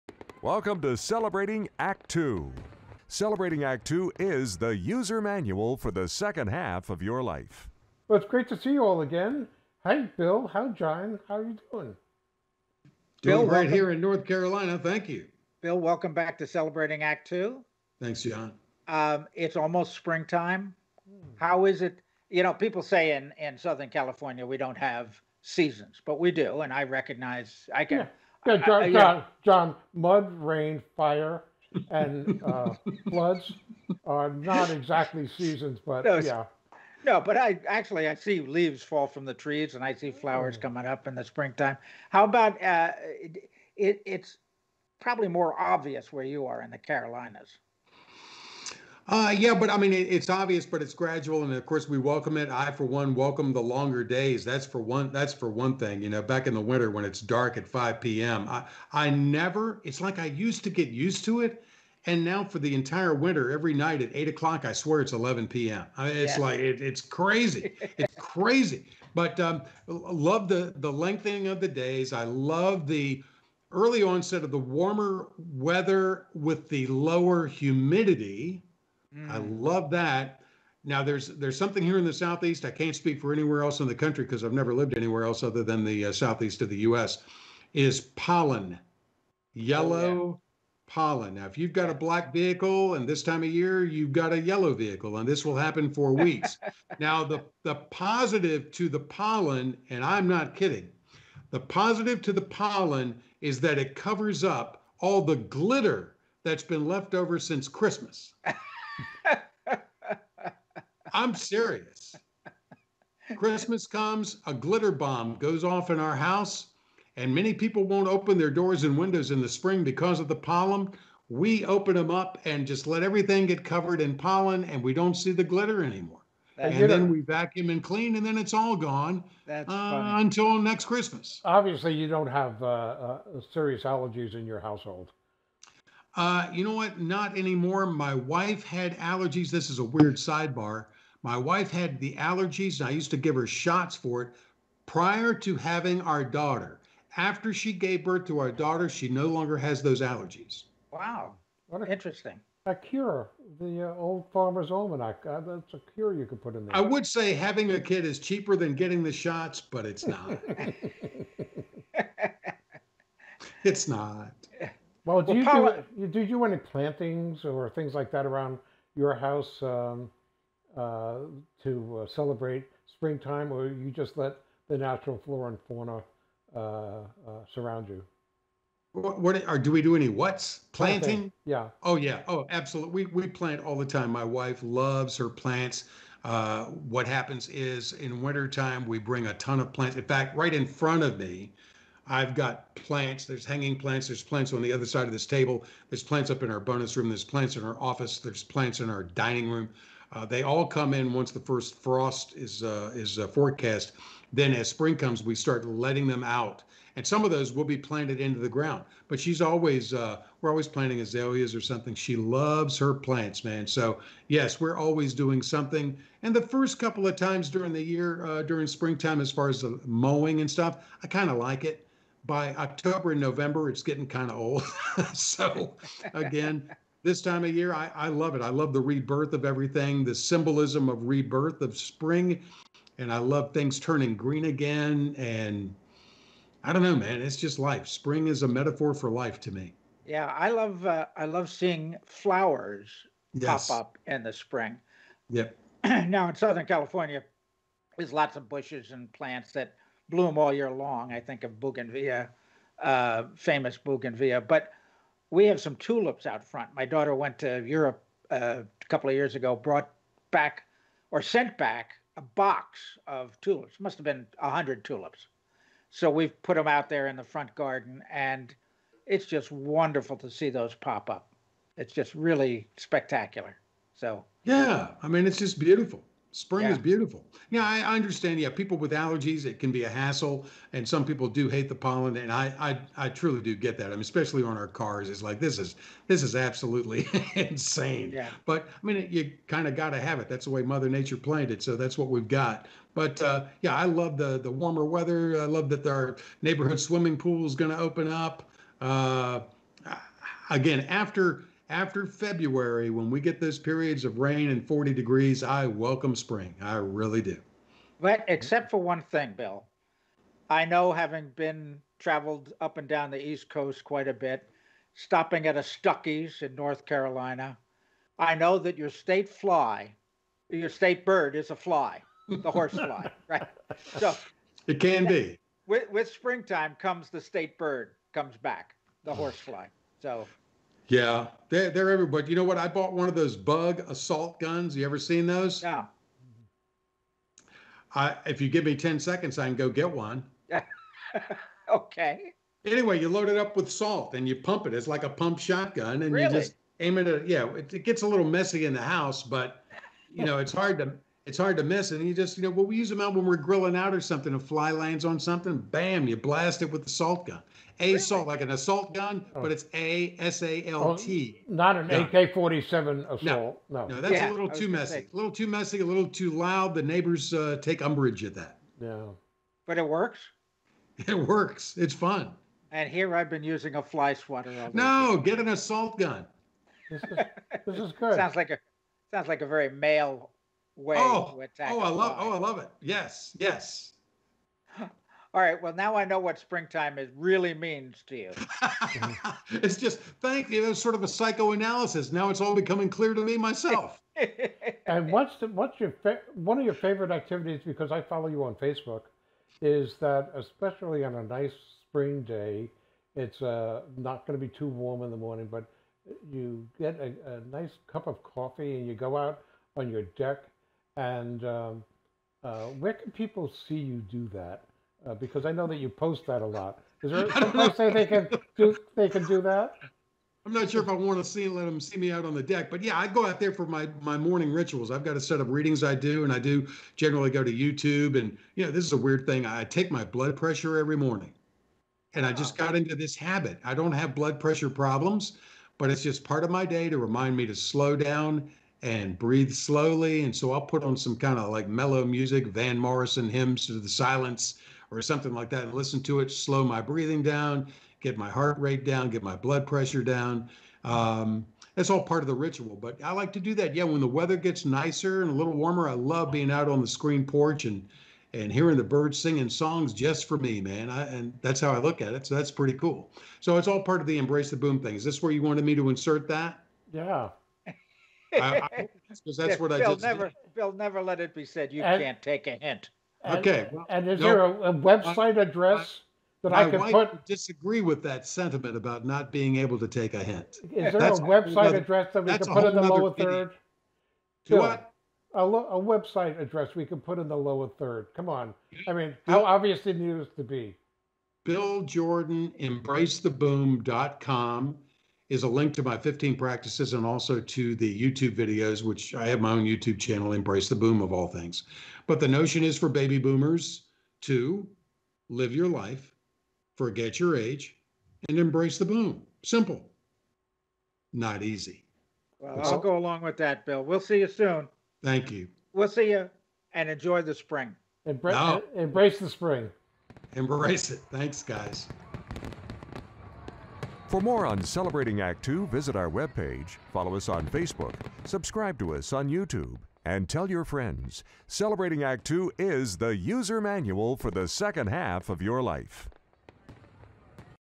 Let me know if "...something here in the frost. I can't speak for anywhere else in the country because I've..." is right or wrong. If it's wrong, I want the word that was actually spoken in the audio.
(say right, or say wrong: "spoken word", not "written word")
wrong: "southeast", not "frost".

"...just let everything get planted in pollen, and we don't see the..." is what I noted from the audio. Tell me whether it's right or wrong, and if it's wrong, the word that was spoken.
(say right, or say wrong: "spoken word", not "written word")
wrong: "covered", not "planted".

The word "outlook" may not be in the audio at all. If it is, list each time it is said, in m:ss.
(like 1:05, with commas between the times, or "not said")
not said.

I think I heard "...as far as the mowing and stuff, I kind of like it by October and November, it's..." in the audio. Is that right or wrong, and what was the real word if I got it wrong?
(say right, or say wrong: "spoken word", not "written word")
right.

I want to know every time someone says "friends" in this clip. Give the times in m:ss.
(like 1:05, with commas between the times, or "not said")
8:50.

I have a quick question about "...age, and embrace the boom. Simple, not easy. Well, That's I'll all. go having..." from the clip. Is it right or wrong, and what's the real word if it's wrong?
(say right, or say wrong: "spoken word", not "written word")
wrong: "along", not "having".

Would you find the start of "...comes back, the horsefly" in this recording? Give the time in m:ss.
5:28.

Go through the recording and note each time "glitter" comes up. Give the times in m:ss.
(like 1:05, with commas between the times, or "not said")
1:45, 1:54, 2:05.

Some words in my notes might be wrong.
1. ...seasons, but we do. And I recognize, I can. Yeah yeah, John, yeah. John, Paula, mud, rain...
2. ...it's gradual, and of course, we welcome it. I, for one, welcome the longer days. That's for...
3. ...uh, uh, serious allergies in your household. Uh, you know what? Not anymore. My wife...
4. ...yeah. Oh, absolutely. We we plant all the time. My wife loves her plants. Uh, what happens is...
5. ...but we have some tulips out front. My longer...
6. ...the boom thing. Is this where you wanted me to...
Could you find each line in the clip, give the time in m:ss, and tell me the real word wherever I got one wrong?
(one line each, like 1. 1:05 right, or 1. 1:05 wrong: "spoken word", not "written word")
1. 0:25 wrong: "John", not "Paula"
2. 0:50 right
3. 2:12 right
4. 3:01 right
5. 4:14 wrong: "daughter", not "longer"
6. 7:44 right.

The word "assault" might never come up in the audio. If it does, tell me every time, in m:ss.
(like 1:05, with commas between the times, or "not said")
5:58, 6:03, 6:15.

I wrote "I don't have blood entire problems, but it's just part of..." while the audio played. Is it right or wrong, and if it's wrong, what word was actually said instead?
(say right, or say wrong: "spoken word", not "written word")
wrong: "pressure", not "entire".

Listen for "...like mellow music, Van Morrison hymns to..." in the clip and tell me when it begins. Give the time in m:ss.
7:21.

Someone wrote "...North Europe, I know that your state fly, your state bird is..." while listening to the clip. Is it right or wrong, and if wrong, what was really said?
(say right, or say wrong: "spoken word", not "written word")
wrong: "Carolina", not "Europe".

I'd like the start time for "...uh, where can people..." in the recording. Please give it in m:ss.
6:52.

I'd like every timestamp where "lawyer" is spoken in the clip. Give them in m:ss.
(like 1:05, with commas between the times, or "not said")
not said.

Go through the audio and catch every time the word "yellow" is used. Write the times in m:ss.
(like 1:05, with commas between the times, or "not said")
1:29, 1:34.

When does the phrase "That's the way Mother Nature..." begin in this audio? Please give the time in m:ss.
4:50.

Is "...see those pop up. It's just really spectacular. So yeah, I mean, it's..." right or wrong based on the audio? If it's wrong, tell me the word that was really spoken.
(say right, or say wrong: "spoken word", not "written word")
right.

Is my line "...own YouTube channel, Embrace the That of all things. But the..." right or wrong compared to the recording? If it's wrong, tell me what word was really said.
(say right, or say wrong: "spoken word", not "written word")
wrong: "Boom", not "That".